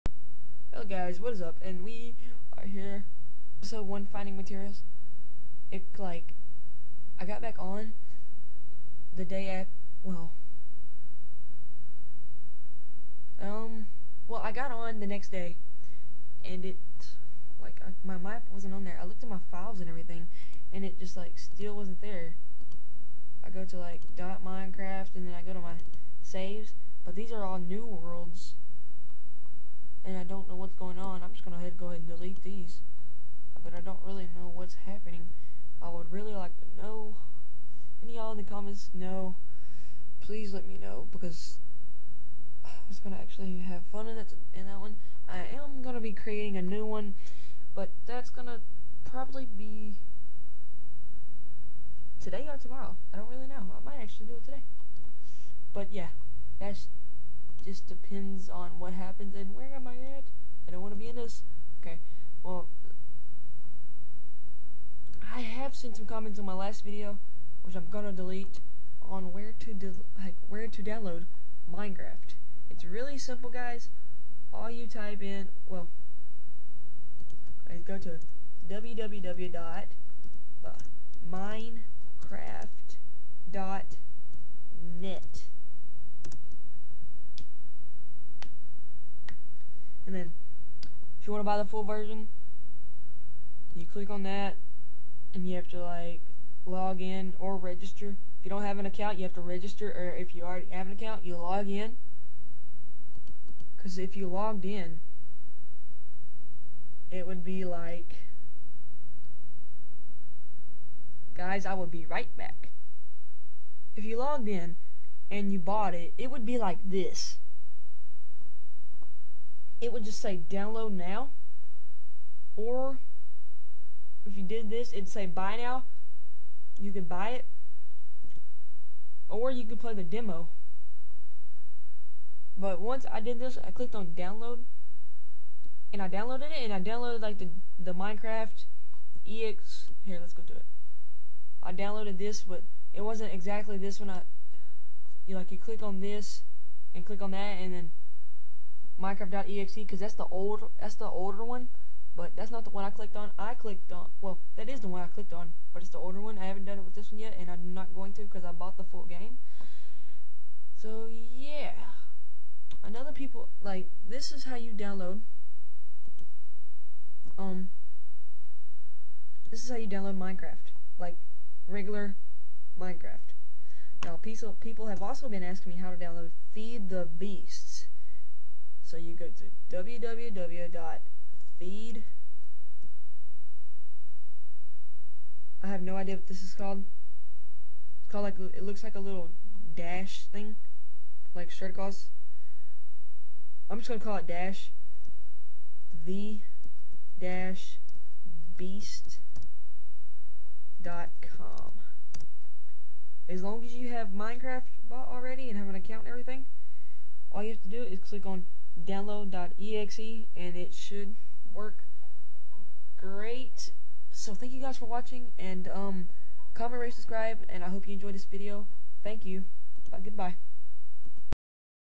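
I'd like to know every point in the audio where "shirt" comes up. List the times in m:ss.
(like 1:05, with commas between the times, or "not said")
3:11.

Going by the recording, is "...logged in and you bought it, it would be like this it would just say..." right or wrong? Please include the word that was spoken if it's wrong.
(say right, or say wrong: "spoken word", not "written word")
right.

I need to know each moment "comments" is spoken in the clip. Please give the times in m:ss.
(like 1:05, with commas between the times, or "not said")
0:38, 1:06, 3:36.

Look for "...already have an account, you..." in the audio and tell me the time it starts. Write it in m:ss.
1:40.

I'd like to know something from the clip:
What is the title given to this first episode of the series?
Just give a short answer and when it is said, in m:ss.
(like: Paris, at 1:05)
Finding Materials, at 0:04.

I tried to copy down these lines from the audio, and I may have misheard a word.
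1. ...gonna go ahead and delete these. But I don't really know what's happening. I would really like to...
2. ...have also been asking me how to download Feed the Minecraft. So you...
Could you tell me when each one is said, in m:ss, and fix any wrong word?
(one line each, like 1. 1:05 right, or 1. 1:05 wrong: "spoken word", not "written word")
1. 0:31 right
2. 2:54 wrong: "Beasts", not "Minecraft".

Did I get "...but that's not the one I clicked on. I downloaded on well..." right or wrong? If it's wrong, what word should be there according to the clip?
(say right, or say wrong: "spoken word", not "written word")
wrong: "clicked", not "downloaded".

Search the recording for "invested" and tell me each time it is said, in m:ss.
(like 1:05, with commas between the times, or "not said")
not said.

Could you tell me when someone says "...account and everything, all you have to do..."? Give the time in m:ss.
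3:25.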